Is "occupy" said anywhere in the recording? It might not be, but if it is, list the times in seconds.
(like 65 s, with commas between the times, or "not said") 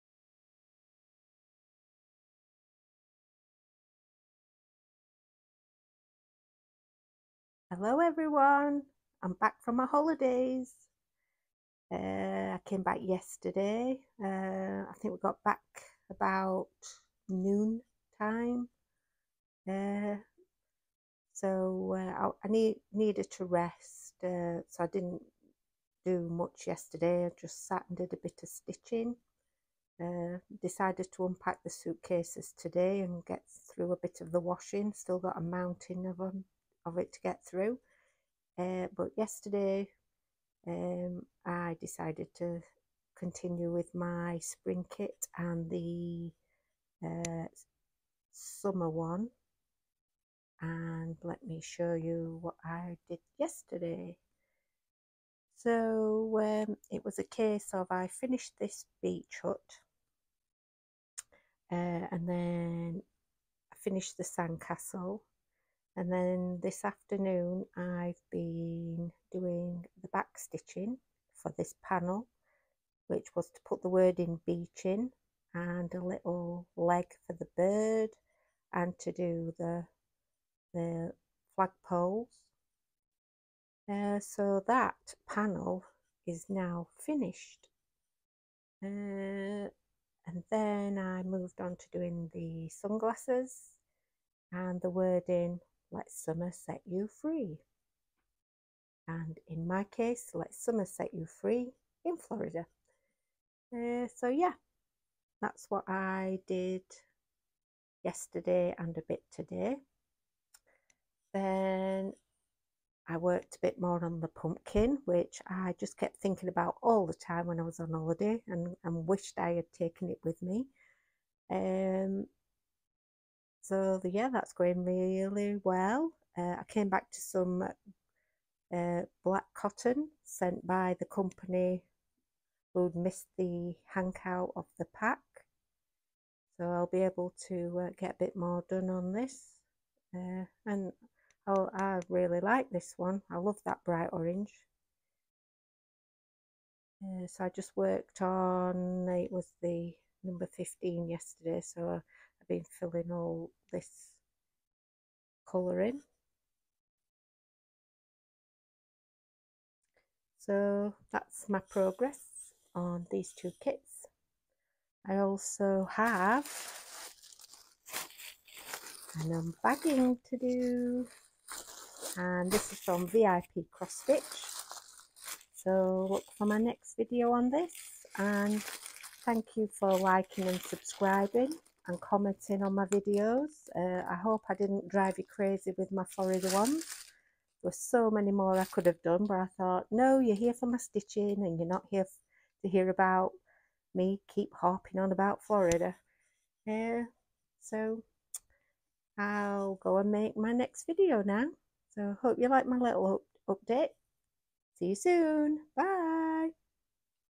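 not said.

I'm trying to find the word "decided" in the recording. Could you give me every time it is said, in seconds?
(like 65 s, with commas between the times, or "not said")
30 s, 41 s.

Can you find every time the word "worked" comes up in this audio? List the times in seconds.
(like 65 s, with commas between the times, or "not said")
113 s, 147 s.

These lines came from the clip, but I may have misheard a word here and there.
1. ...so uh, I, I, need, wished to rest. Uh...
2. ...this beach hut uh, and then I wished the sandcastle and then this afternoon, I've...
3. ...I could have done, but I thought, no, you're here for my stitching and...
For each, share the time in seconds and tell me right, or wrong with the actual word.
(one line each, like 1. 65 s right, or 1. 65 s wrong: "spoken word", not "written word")
1. 21 s wrong: "needed", not "wished"
2. 58 s wrong: "finished", not "wished"
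3. 188 s right.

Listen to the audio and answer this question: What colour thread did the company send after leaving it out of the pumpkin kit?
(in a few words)
black.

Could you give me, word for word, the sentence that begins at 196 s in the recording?
Yeah, so I'll go and make my next video now.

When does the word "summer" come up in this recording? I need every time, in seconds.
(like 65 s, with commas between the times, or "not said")
48 s, 96 s, 100 s.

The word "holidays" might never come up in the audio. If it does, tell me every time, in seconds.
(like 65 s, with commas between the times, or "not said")
9 s, 117 s.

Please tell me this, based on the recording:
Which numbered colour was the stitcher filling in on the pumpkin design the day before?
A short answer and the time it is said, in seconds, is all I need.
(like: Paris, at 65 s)
15, at 150 s.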